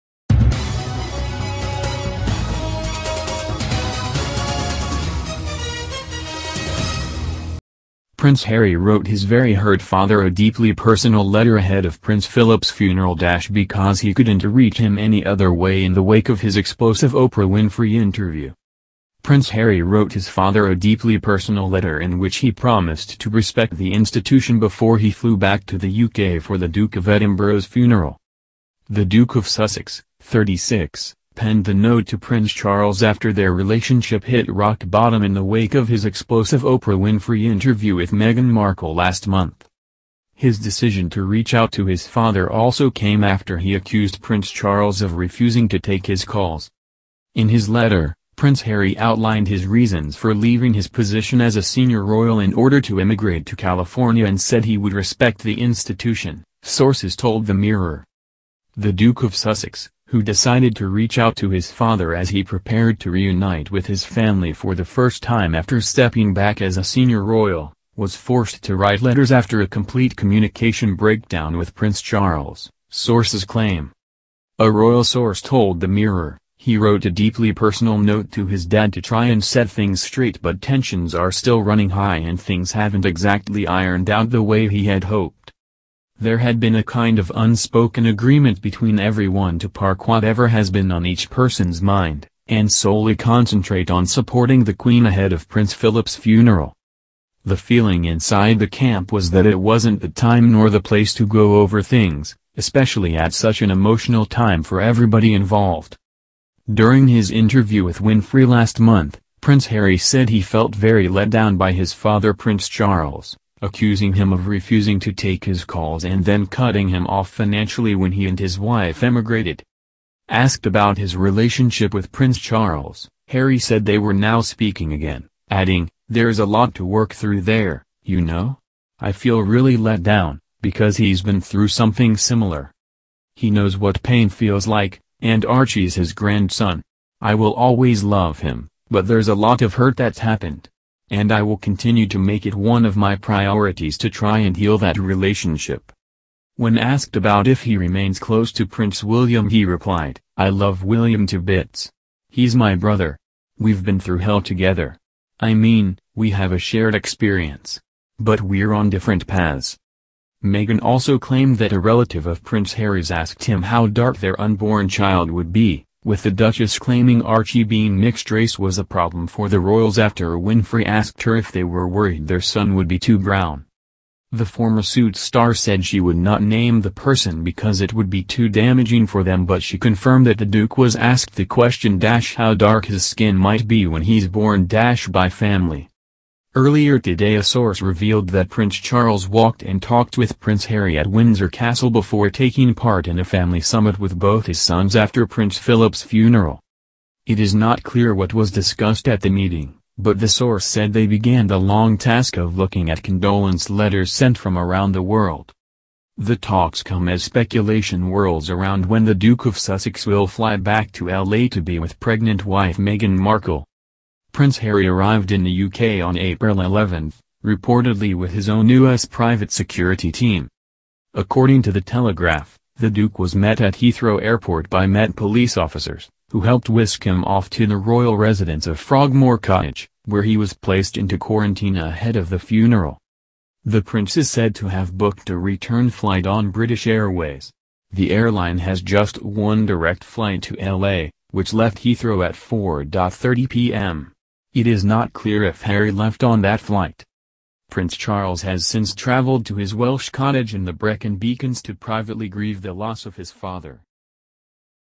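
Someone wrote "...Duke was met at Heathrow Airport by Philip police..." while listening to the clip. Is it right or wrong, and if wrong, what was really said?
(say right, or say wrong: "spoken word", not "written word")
wrong: "Met", not "Philip".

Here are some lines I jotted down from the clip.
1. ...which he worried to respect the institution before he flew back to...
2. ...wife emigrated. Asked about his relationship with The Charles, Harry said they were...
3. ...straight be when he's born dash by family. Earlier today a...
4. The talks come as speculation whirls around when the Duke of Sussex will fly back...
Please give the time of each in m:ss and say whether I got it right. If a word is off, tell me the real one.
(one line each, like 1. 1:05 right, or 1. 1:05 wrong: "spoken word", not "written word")
1. 0:22 wrong: "promised", not "worried"
2. 1:58 wrong: "Prince", not "The"
3. 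3:03 wrong: "might", not "straight"
4. 3:26 right.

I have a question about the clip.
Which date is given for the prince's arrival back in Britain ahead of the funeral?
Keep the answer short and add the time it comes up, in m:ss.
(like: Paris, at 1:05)
April 11, at 3:36.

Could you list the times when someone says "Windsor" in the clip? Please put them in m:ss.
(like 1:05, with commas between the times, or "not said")
3:11.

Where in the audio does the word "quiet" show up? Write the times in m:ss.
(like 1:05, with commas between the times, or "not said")
not said.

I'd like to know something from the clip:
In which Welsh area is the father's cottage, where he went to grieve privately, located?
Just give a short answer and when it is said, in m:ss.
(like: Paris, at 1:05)
Brecon Beacons, at 4:10.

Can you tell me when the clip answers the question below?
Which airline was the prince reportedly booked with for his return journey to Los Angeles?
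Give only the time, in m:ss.
3:56.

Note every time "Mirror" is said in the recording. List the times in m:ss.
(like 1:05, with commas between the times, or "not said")
0:57, 1:15.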